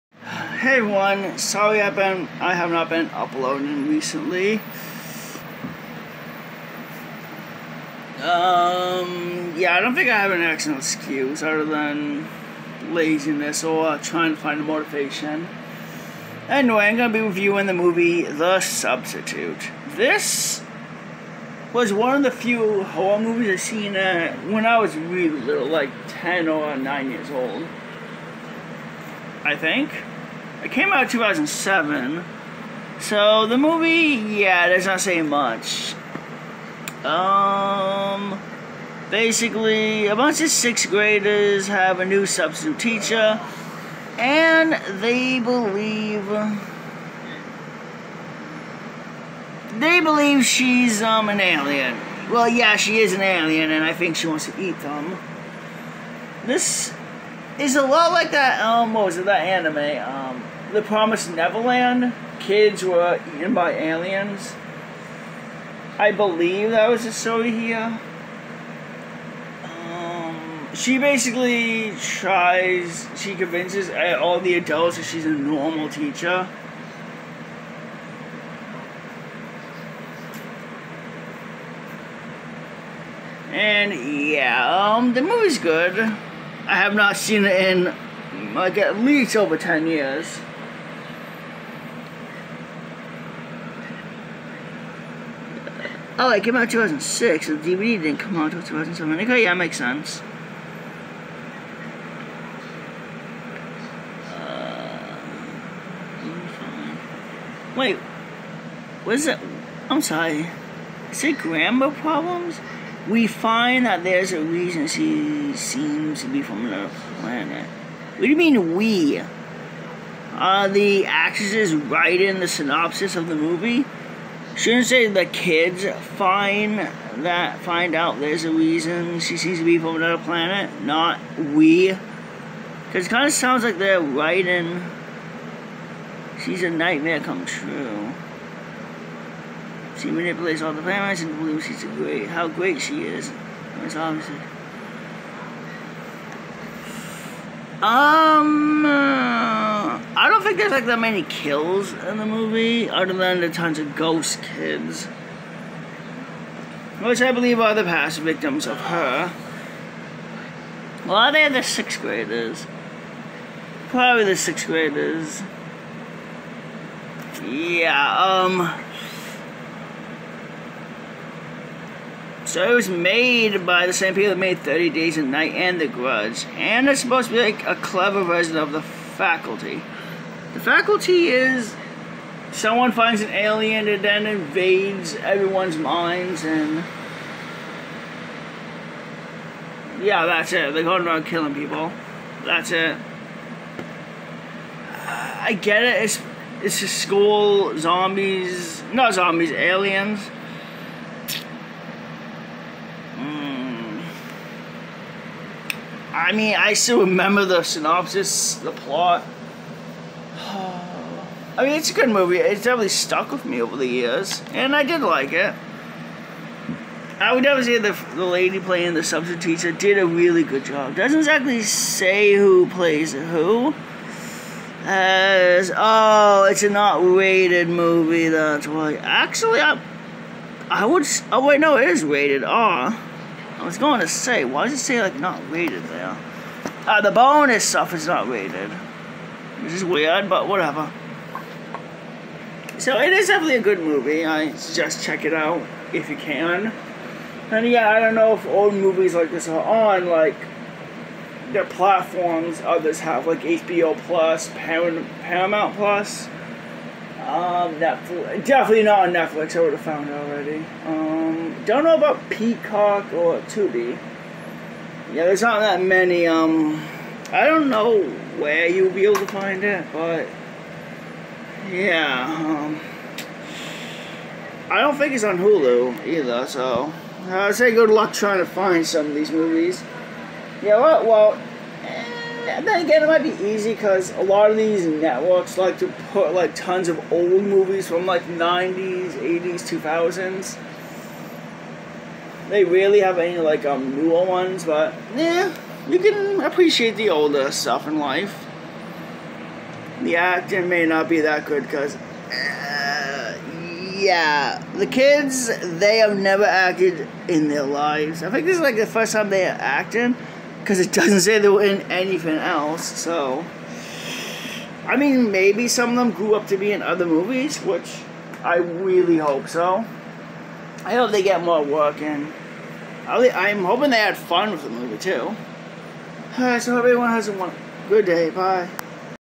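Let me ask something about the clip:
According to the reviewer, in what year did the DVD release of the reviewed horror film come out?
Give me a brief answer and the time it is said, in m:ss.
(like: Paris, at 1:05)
2007, at 1:37.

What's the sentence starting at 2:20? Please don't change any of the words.
She manipulates all the parents and believes she's great, how great she is.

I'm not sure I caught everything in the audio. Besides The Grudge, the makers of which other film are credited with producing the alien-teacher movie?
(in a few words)
30 Days of Night.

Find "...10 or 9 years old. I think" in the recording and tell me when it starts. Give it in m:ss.
0:26.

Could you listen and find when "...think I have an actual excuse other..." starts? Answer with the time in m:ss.
0:09.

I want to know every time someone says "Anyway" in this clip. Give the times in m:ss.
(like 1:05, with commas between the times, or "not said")
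0:16.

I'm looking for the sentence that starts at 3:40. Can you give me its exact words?
Doesn't exactly say who plays who.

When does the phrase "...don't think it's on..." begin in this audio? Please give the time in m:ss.
4:34.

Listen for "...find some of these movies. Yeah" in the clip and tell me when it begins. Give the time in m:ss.
4:38.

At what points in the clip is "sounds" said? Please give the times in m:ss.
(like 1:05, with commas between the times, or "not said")
2:13.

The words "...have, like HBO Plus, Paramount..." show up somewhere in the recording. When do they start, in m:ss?
4:13.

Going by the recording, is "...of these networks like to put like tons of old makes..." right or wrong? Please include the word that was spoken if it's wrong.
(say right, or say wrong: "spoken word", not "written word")
wrong: "movies", not "makes".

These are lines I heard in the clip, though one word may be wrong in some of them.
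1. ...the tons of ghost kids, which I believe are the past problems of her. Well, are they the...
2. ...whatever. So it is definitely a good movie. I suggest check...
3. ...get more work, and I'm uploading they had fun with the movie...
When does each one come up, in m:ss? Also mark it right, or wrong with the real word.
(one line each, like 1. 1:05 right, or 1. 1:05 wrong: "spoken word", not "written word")
1. 2:33 wrong: "victims", not "problems"
2. 4:00 right
3. 5:21 wrong: "hoping", not "uploading".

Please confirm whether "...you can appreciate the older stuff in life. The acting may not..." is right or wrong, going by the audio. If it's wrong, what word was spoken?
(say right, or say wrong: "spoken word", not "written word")
right.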